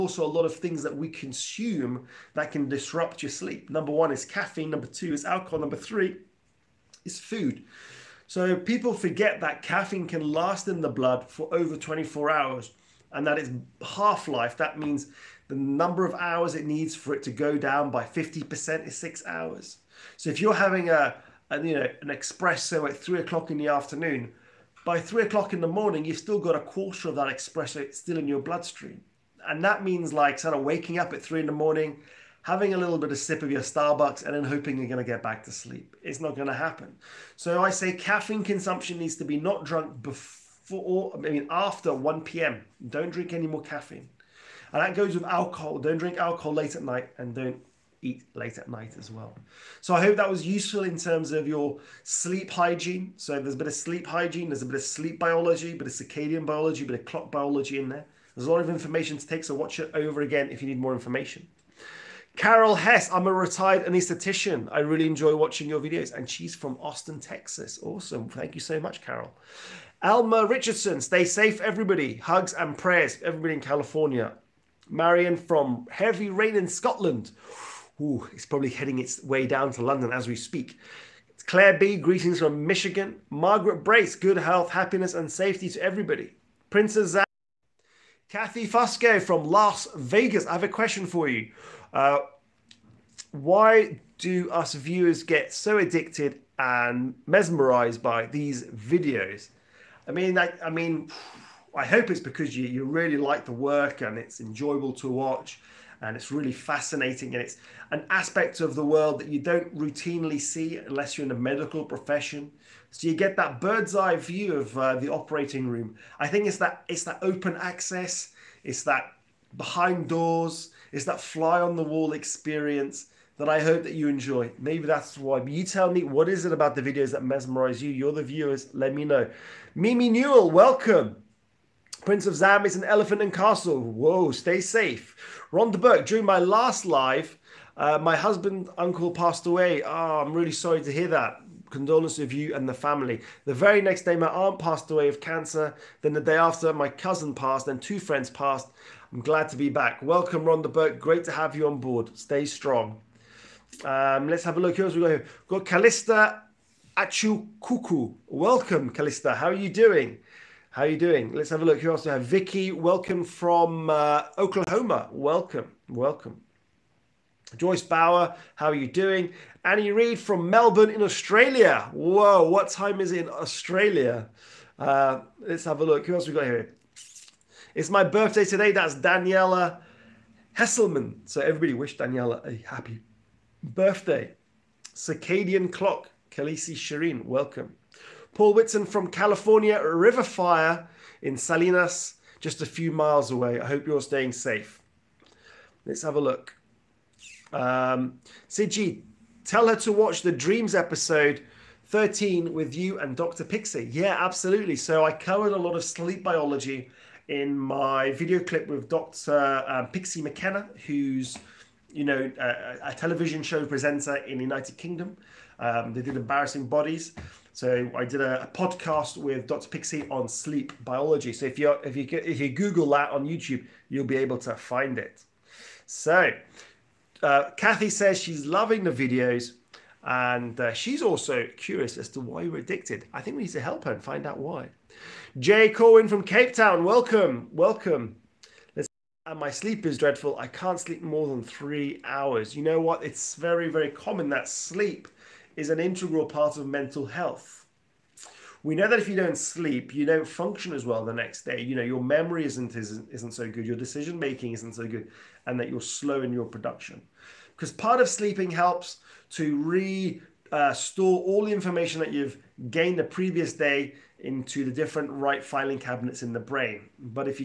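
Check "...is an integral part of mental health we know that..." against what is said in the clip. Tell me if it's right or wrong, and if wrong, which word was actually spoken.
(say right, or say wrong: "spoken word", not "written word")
right.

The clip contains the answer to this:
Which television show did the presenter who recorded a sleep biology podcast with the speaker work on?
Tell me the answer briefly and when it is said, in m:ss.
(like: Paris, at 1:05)
Embarrassing Bodies, at 3:36.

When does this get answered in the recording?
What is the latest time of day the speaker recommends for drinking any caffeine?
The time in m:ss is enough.
0:41.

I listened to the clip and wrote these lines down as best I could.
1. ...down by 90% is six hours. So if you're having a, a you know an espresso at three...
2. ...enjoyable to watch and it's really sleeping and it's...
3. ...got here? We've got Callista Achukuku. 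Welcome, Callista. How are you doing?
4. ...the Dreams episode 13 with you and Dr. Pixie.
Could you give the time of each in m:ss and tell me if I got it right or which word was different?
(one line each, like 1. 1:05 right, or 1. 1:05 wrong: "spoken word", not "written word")
1. 0:17 wrong: "50", not "90"
2. 1:44 wrong: "fascinating", not "sleeping"
3. 2:35 right
4. 3:20 right.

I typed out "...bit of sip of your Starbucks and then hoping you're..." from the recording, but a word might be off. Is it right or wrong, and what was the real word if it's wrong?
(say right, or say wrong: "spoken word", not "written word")
right.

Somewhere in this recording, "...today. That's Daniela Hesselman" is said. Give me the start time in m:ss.
2:58.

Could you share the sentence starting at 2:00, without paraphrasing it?
It's that fly on the wall experience that I hope that you enjoy.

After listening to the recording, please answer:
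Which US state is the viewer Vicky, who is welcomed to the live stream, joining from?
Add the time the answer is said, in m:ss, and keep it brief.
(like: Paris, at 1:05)
Oklahoma, at 2:44.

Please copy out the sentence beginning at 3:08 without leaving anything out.
Paul Whitson from California, River Fire in Salinas, just a few miles away.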